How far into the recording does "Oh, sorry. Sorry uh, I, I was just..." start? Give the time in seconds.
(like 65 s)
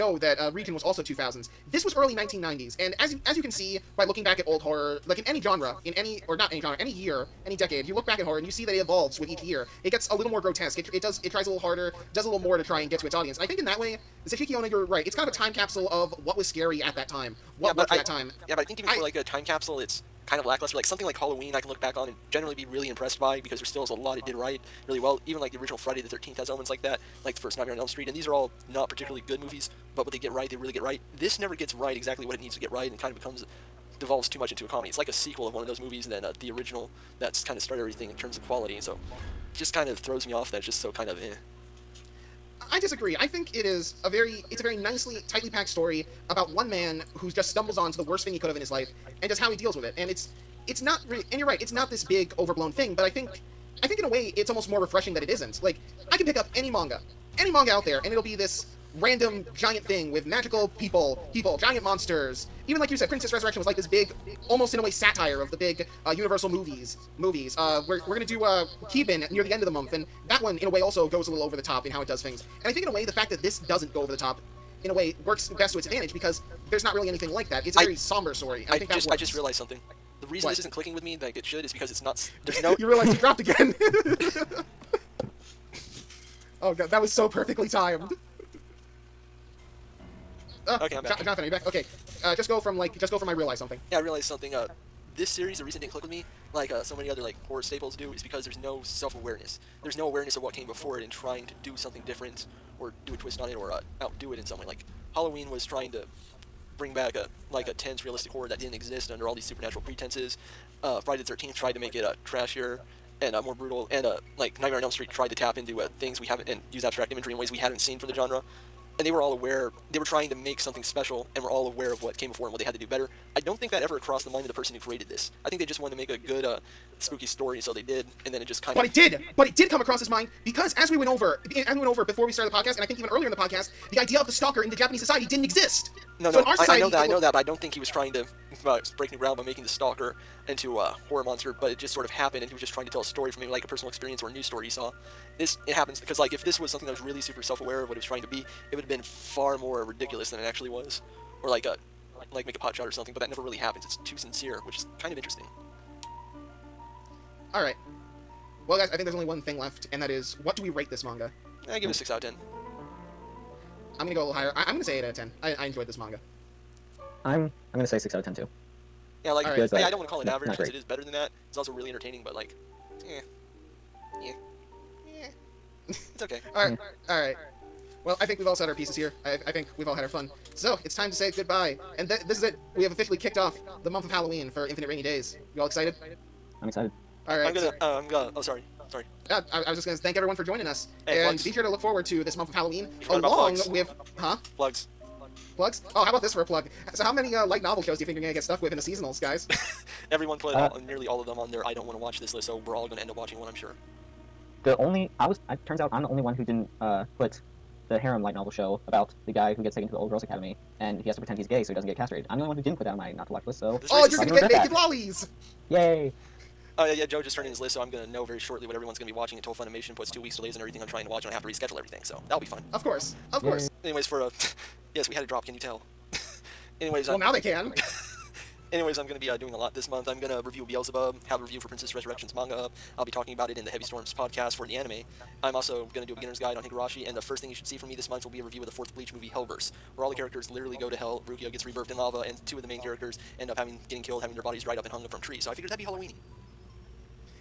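188 s.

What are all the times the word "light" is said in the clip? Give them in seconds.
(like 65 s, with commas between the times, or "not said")
197 s, 208 s.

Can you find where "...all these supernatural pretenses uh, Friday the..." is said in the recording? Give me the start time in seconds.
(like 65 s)
109 s.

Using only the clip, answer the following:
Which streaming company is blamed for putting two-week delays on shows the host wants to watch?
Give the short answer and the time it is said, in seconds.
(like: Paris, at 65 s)
Funimation, at 219 s.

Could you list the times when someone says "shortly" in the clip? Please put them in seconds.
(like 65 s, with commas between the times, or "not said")
218 s.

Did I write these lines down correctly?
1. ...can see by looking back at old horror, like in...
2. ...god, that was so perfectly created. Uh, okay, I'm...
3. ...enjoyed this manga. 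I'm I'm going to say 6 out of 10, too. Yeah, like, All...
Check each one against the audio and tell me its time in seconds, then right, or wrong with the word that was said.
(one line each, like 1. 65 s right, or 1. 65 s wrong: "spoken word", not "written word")
1. 3 s right
2. 86 s wrong: "timed", not "created"
3. 165 s right.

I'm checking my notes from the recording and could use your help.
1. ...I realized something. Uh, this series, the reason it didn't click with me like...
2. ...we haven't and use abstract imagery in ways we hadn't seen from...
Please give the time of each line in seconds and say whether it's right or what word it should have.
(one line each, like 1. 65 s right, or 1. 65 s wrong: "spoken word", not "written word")
1. 93 s right
2. 116 s right.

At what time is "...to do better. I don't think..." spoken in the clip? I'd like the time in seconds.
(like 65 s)
122 s.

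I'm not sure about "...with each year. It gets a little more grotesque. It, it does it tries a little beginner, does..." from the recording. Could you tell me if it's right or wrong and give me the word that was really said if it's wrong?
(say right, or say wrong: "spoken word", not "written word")
wrong: "harder", not "beginner".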